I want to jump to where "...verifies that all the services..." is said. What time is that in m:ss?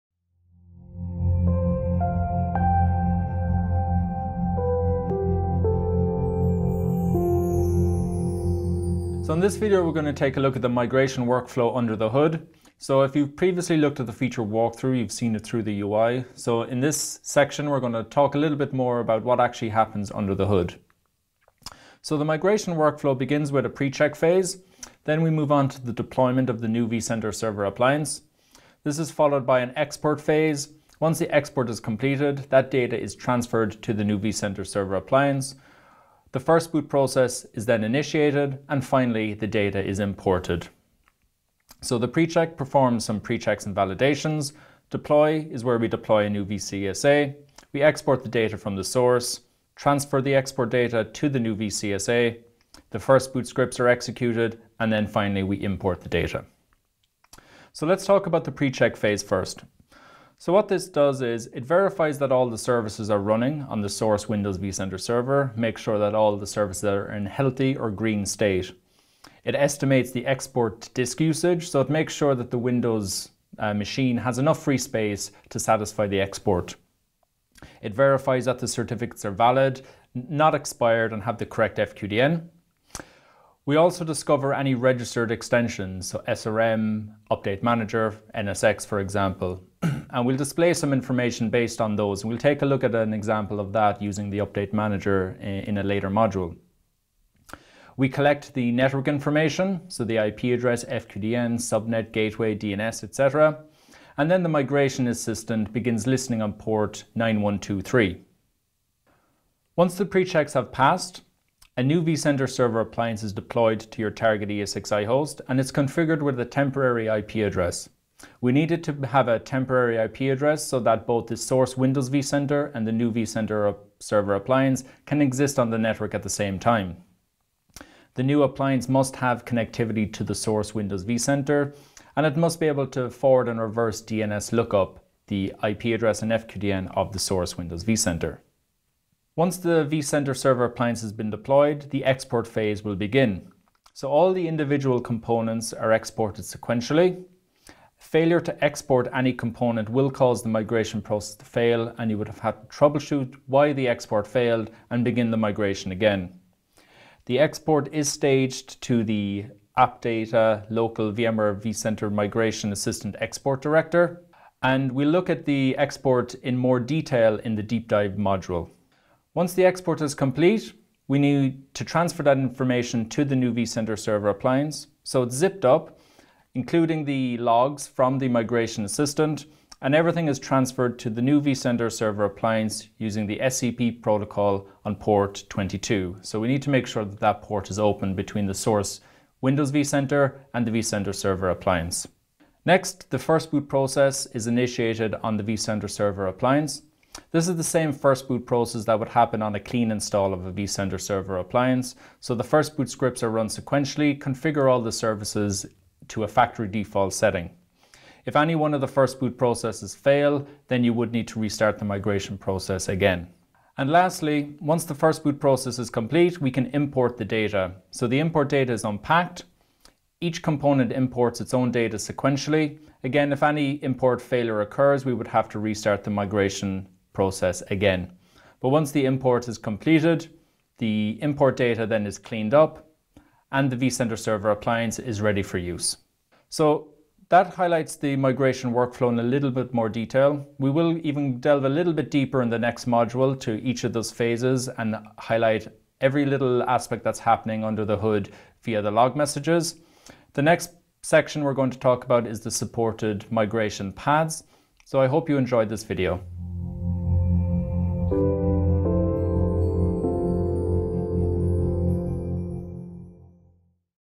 1:01.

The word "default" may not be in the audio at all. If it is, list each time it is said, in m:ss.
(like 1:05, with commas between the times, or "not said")
3:26.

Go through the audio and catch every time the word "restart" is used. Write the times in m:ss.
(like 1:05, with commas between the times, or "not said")
3:31, 3:45.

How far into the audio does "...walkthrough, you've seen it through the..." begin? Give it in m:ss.
0:14.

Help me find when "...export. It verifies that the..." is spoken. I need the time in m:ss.
1:16.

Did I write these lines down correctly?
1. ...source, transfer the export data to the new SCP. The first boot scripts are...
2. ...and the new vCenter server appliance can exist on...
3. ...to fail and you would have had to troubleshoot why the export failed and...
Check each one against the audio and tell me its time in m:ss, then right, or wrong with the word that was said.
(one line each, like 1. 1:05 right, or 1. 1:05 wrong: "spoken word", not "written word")
1. 0:48 wrong: "VCSA", not "SCP"
2. 2:02 right
3. 2:31 right.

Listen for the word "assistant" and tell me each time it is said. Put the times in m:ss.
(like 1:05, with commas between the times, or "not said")
1:45, 2:42, 2:58.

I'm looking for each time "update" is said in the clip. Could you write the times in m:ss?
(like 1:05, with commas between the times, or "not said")
1:27, 1:34.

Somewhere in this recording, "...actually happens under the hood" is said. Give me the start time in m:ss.
0:19.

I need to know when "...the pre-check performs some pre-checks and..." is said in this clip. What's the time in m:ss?
0:41.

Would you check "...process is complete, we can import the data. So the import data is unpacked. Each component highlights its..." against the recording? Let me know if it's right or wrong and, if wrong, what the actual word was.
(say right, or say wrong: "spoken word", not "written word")
wrong: "imports", not "highlights".